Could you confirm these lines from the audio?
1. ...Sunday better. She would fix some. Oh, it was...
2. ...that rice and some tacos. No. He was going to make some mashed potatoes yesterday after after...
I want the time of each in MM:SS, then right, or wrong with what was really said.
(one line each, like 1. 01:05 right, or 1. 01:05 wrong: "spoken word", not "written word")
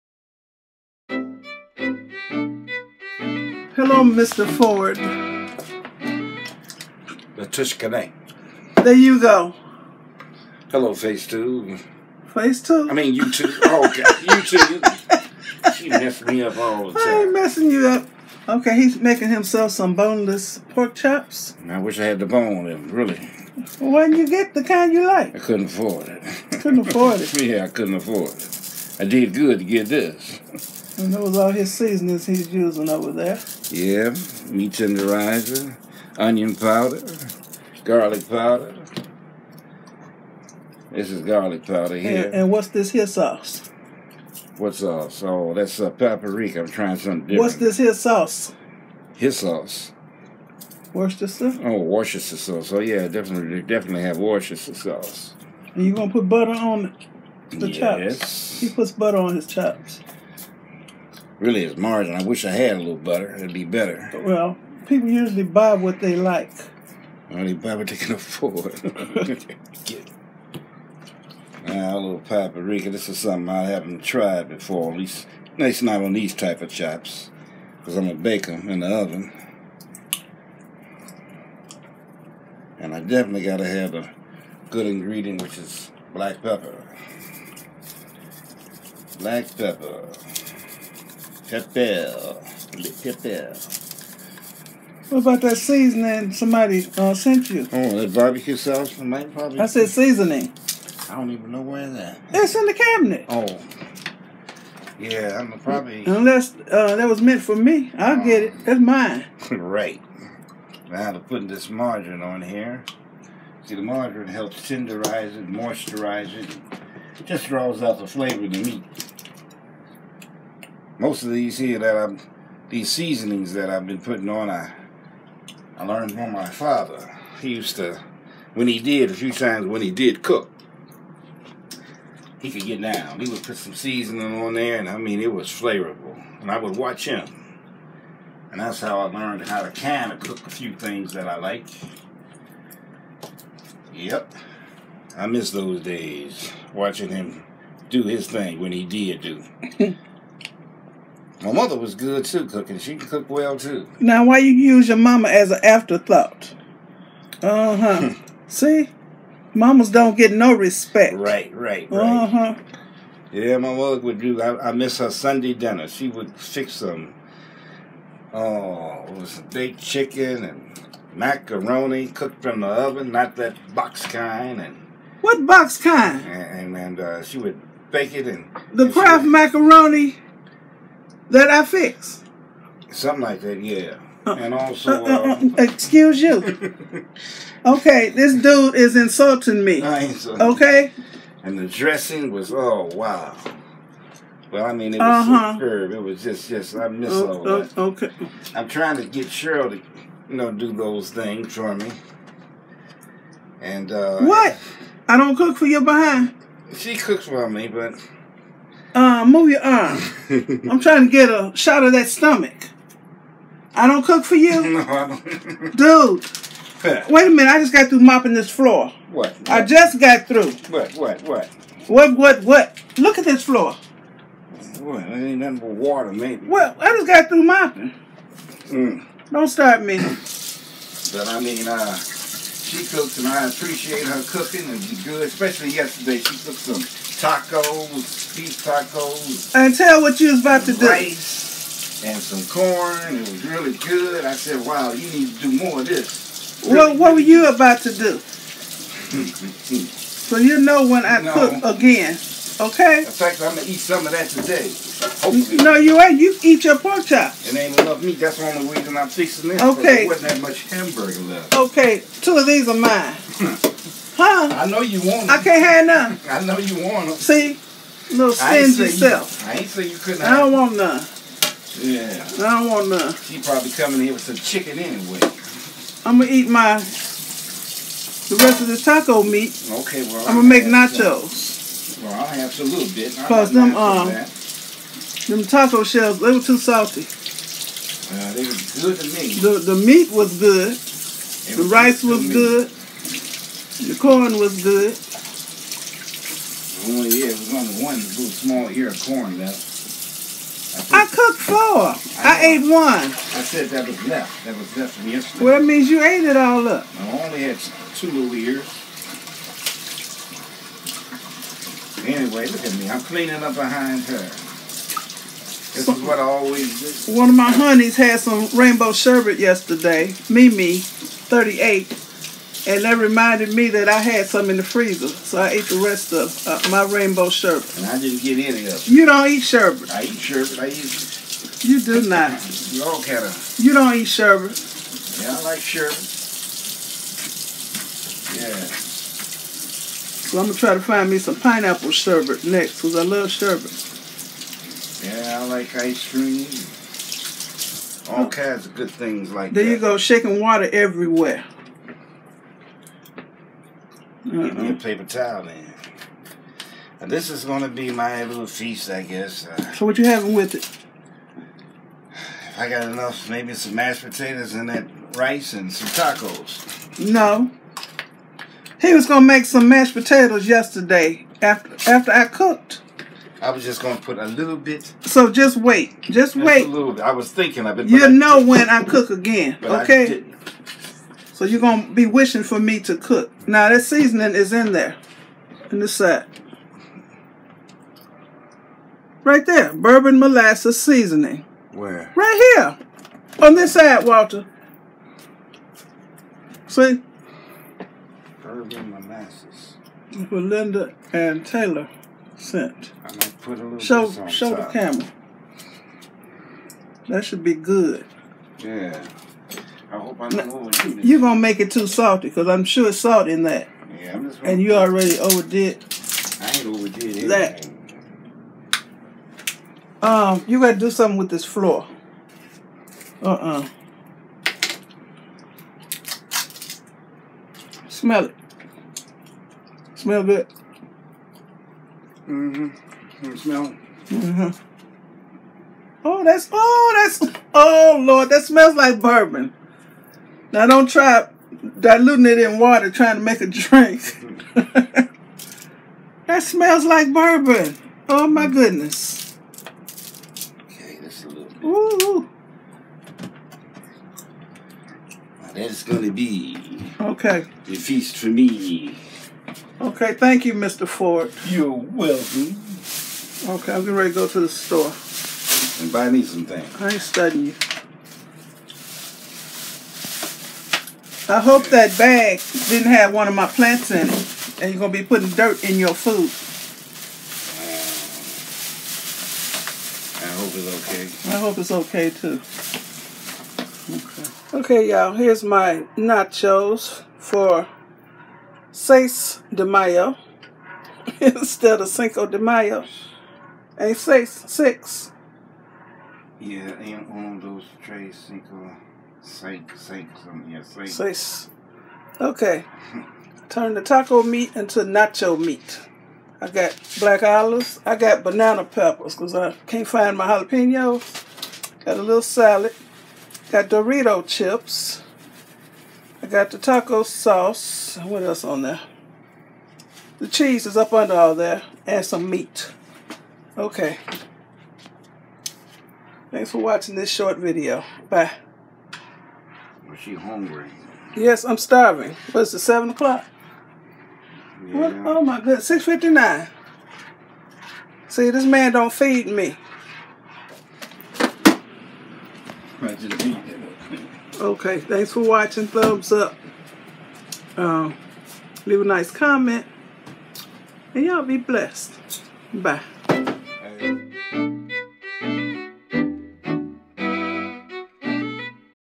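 1. 02:45 wrong: "dinner", not "better"
2. 06:04 right.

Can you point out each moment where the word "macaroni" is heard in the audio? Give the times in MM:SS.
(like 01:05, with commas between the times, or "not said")
02:51, 02:59.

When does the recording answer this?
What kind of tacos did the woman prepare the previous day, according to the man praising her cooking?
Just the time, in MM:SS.
03:58.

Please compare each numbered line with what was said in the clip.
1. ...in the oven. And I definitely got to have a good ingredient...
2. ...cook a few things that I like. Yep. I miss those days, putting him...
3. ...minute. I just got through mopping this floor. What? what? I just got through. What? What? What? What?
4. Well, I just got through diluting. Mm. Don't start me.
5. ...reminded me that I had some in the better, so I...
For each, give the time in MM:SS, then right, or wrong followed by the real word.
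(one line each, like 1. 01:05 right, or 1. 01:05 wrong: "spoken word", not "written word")
1. 01:18 right
2. 02:20 wrong: "watching", not "putting"
3. 03:37 right
4. 03:46 wrong: "mopping", not "diluting"
5. 05:22 wrong: "freezer", not "better".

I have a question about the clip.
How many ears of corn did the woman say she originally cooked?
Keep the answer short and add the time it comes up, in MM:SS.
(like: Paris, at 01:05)
4, at 05:01.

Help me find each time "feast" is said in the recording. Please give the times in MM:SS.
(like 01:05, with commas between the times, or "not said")
05:58, 07:37.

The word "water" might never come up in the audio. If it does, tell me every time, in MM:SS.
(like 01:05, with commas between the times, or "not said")
03:45, 05:50, 07:22.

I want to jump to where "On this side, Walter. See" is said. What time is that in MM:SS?
06:33.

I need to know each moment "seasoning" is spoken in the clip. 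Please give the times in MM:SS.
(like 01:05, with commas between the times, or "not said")
00:31, 01:35, 01:39, 02:02, 02:13, 06:23, 06:30.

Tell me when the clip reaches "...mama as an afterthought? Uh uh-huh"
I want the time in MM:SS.
02:34.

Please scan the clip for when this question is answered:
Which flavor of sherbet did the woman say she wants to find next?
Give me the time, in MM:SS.
05:41.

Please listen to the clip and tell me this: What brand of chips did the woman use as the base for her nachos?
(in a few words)
Dorito.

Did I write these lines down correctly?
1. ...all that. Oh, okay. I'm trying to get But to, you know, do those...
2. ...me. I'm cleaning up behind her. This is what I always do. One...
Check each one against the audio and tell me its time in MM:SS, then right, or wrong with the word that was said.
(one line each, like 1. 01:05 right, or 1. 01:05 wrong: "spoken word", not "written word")
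1. 03:17 wrong: "Cheryl", not "But"
2. 05:12 right.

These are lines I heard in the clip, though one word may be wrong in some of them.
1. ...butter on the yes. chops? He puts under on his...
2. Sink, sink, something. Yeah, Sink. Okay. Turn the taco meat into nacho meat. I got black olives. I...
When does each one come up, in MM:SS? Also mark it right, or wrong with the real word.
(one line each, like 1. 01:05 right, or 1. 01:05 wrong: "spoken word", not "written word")
1. 00:56 wrong: "butter", not "under"
2. 08:19 right.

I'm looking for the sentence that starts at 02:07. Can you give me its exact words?
He used to, when he did, a few times when he did cook, he could get down.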